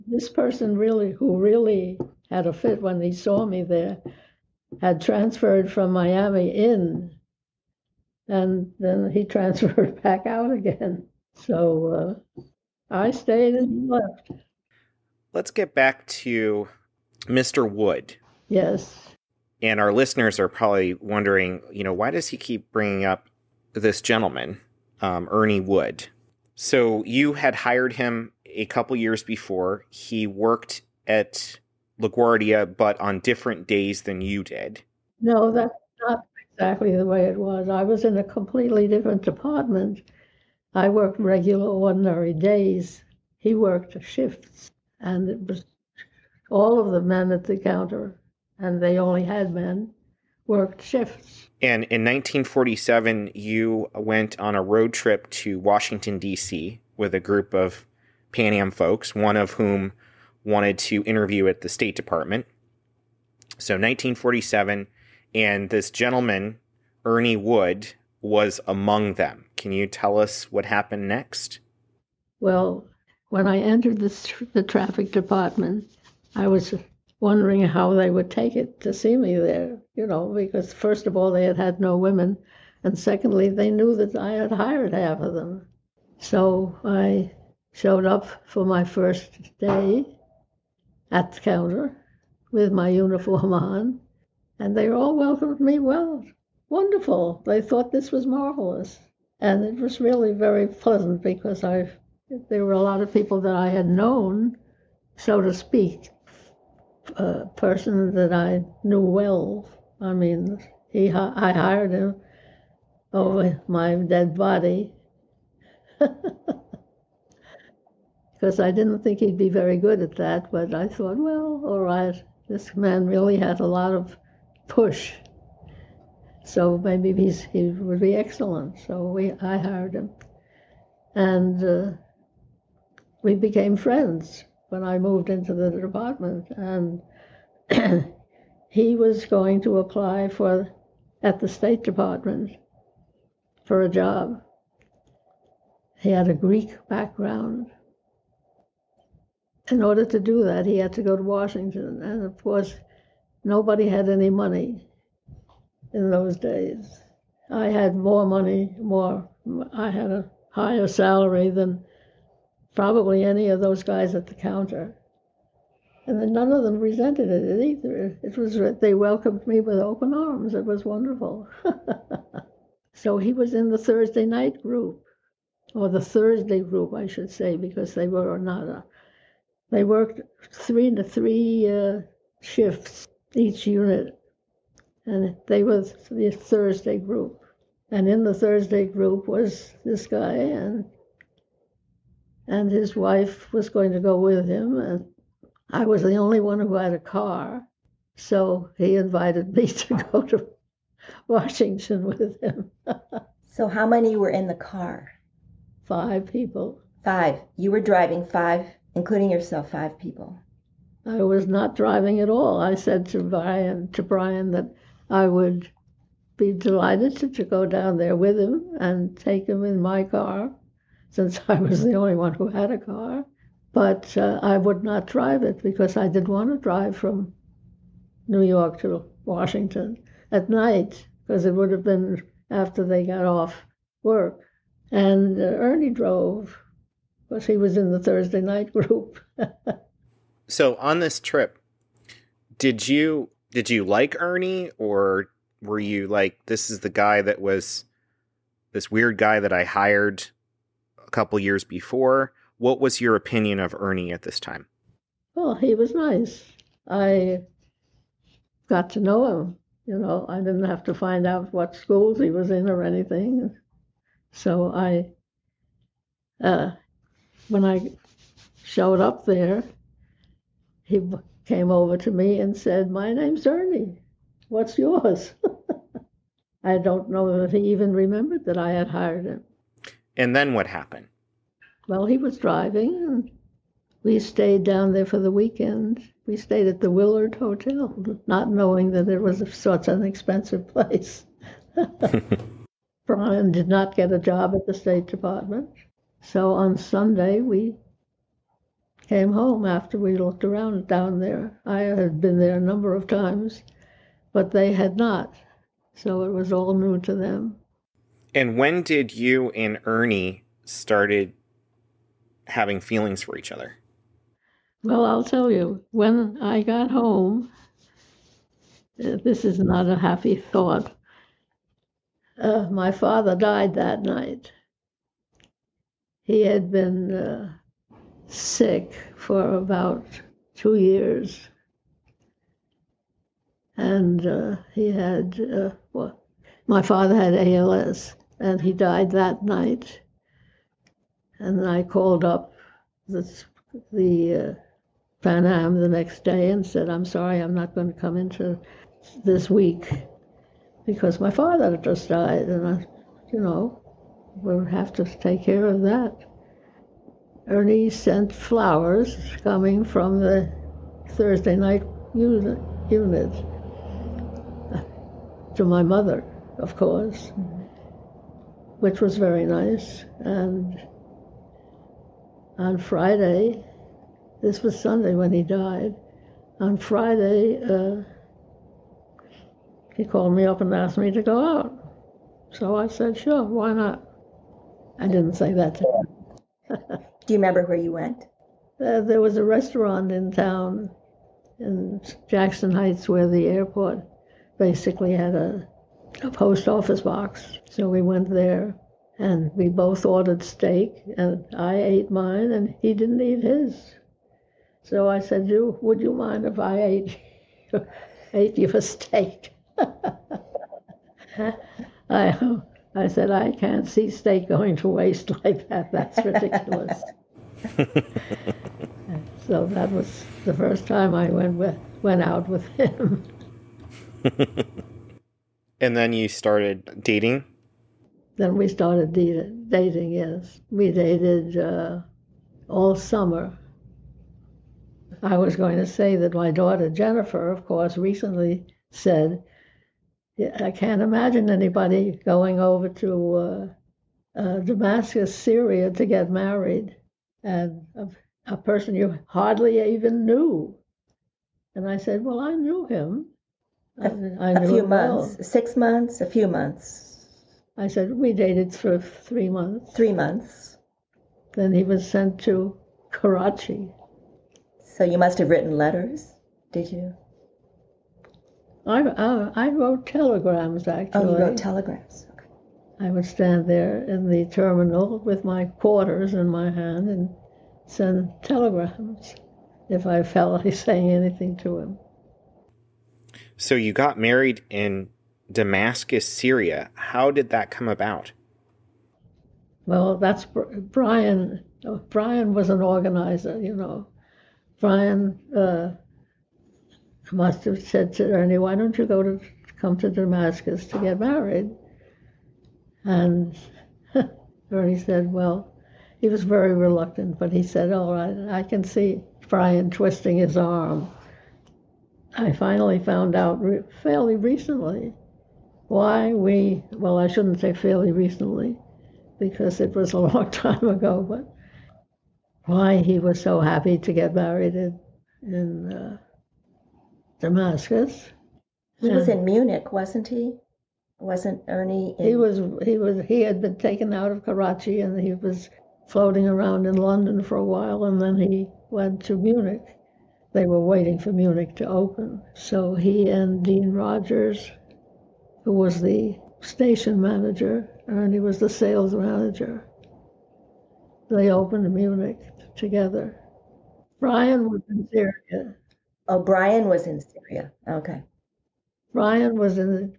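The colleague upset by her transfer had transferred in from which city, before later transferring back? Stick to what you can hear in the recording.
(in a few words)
Miami.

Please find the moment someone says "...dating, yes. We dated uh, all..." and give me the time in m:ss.
7:09.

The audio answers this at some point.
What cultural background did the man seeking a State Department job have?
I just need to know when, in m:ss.
2:26.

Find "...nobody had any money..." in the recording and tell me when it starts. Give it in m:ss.
2:33.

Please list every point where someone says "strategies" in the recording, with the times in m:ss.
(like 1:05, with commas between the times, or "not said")
not said.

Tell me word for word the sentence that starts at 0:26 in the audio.
So you had hired him a couple years before.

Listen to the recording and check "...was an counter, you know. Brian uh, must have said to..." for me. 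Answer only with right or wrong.
wrong.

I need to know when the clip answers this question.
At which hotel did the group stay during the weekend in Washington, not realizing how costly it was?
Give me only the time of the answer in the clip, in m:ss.
4:46.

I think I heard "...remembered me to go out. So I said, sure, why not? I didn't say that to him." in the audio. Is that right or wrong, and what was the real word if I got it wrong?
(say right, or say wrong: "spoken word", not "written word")
wrong: "asked", not "remembered".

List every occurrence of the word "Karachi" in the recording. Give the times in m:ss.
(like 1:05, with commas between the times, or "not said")
7:43, 8:54.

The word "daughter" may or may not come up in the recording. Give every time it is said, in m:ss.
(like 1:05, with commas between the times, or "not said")
7:16.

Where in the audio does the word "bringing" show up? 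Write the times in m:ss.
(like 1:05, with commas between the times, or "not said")
0:22.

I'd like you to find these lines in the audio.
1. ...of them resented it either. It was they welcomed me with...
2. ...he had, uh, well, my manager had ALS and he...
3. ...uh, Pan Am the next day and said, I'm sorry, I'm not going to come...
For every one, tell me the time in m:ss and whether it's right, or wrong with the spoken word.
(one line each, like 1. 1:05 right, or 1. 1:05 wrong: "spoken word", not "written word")
1. 2:46 right
2. 5:34 wrong: "father", not "manager"
3. 5:44 right.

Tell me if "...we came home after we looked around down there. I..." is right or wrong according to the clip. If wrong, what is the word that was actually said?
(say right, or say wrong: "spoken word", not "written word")
right.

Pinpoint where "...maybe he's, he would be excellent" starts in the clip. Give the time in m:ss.
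2:06.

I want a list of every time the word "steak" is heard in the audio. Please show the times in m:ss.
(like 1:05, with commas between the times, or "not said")
6:40, 6:48, 6:54.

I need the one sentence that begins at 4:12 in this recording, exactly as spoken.
What was your opinion of Ernie at this time?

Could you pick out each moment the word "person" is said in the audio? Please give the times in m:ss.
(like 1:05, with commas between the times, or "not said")
0:00, 1:47, 7:28.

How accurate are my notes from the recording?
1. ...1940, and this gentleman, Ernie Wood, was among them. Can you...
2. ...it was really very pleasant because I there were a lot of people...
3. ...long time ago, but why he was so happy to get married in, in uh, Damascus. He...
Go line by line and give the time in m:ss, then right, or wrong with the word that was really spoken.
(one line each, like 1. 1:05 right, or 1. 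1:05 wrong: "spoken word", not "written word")
1. 1:03 wrong: "1947", not "1940"
2. 1:39 right
3. 8:40 right.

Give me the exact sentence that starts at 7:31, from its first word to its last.
And I said, Well, I knew him.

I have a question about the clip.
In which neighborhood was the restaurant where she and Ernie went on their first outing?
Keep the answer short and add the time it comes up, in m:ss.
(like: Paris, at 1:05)
Jackson Heights, at 6:32.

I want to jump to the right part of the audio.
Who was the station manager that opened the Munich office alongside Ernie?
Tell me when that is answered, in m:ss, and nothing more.
9:03.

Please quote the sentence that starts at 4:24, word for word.
So I, uh, when I showed up there, he came over to me and said, My name's Ernie.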